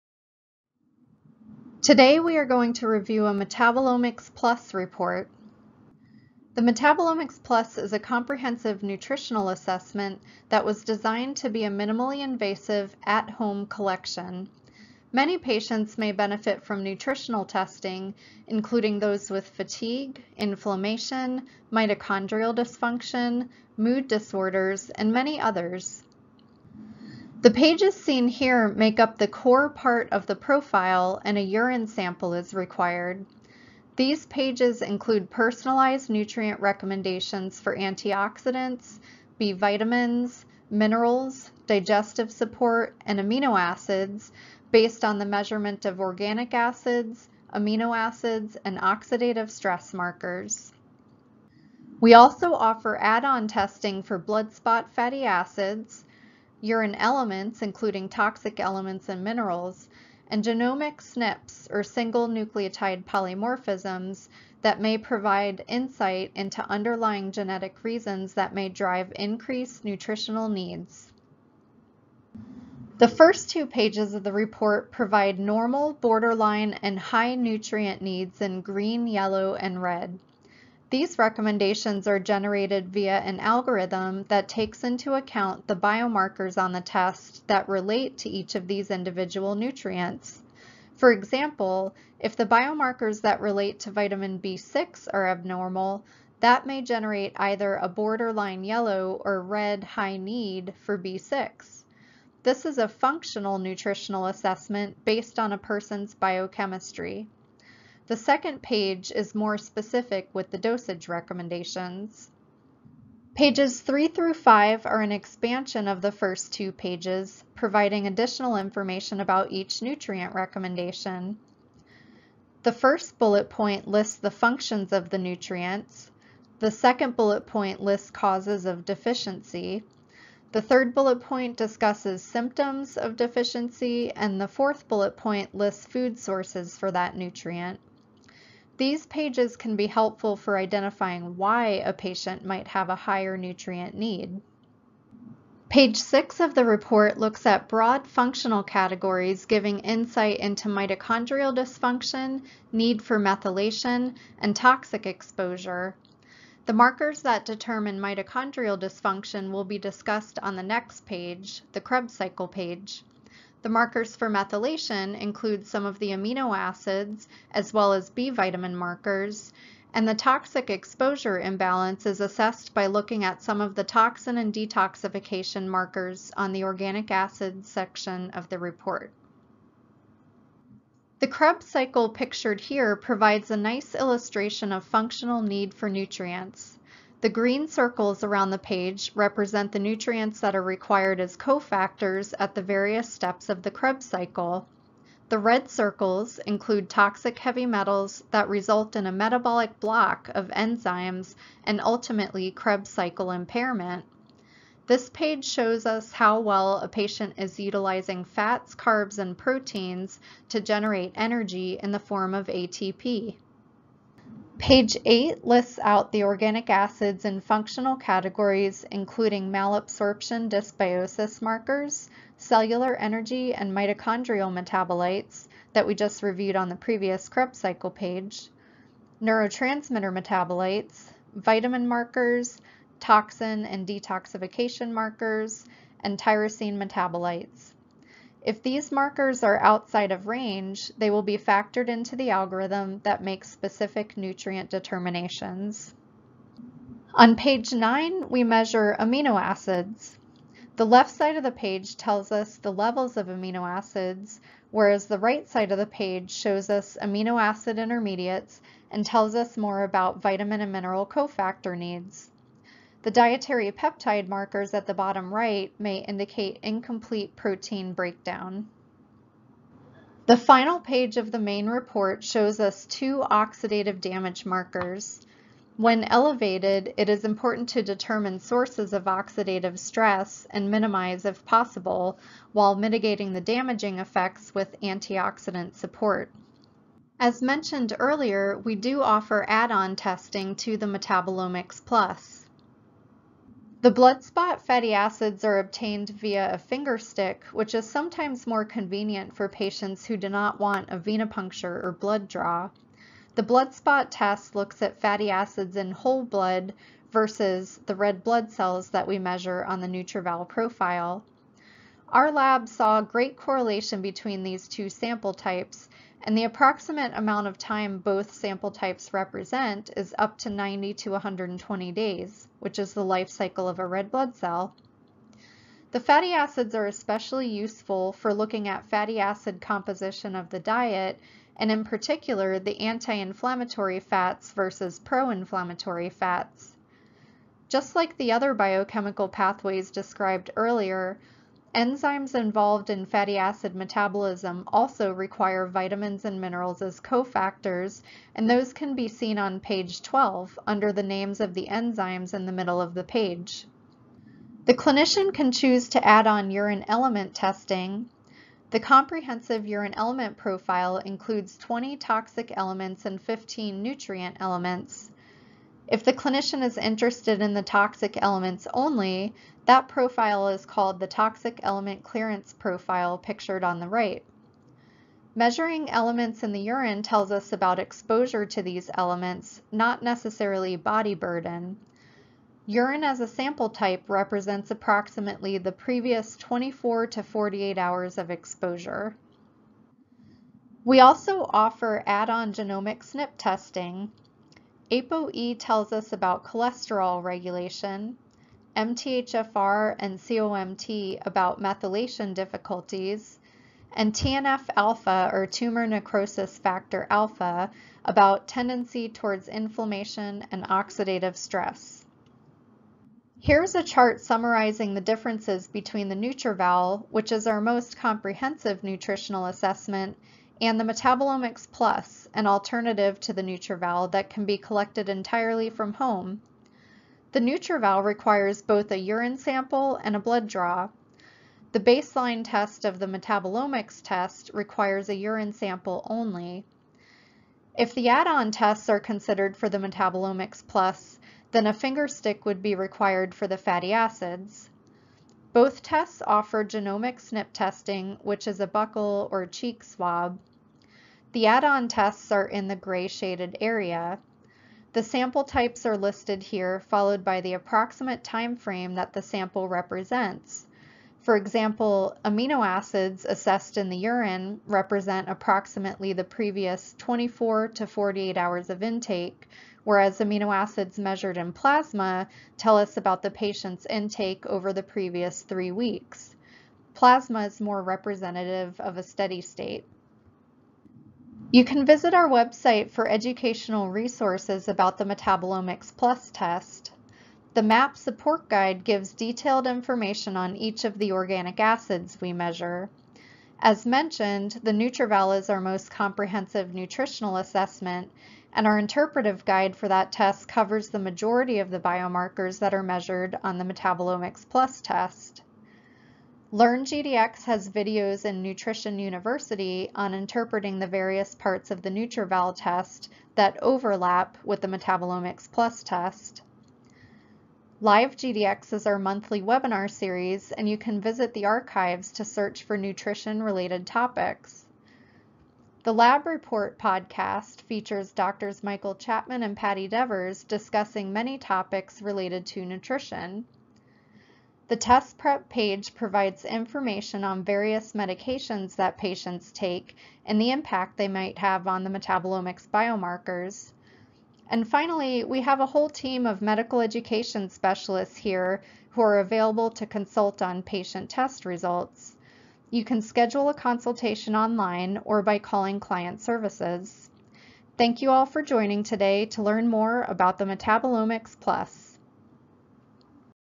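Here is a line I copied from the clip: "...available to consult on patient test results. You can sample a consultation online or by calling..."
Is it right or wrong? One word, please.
wrong.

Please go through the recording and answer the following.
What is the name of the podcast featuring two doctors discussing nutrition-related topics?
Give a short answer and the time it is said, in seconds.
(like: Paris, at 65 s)
The Lab Report, at 525 s.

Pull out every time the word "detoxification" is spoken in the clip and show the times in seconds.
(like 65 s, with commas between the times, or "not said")
174 s, 233 s.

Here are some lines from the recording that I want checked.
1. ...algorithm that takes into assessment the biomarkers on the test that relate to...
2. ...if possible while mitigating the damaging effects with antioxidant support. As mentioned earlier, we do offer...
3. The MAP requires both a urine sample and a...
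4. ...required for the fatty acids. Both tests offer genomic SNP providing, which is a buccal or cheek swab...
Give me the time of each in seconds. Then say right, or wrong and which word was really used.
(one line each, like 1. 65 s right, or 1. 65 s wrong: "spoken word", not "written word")
1. 83 s wrong: "account", not "assessment"
2. 281 s right
3. 427 s wrong: "NutrEval", not "MAP"
4. 442 s wrong: "testing", not "providing".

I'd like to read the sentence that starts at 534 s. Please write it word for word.
The test prep page provides information on various medications that patients take and the impact they might have on the metabolomics biomarkers.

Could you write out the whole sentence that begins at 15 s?
Many patients may benefit from nutritional testing, including those with fatigue, inflammation, mitochondrial dysfunction, mood disorders, and many others.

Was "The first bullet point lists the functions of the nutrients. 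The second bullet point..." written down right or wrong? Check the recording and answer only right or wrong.
right.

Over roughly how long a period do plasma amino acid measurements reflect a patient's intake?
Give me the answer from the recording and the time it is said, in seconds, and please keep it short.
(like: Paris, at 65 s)
3 weeks, at 475 s.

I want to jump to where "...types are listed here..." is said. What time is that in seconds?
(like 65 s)
455 s.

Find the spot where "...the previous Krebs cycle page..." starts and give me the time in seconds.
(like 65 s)
226 s.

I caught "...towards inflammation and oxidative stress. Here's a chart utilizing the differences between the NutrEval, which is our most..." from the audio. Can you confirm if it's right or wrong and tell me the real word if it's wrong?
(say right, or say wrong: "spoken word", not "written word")
wrong: "summarizing", not "utilizing".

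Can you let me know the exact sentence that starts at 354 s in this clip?
The clinician can choose to add on urine element testing.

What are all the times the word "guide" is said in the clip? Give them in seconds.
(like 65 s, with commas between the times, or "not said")
488 s, 499 s.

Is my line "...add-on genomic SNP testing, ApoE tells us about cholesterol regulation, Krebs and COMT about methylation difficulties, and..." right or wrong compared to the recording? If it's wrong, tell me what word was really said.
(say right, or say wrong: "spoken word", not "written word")
wrong: "MTHFR", not "Krebs".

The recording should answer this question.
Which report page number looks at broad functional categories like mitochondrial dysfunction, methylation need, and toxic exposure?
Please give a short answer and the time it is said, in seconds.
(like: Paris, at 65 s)
Page 6, at 145 s.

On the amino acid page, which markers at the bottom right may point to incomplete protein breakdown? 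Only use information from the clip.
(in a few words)
dietary peptide markers.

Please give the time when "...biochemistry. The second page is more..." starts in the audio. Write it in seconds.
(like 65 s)
106 s.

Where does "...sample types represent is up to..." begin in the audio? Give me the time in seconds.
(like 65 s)
318 s.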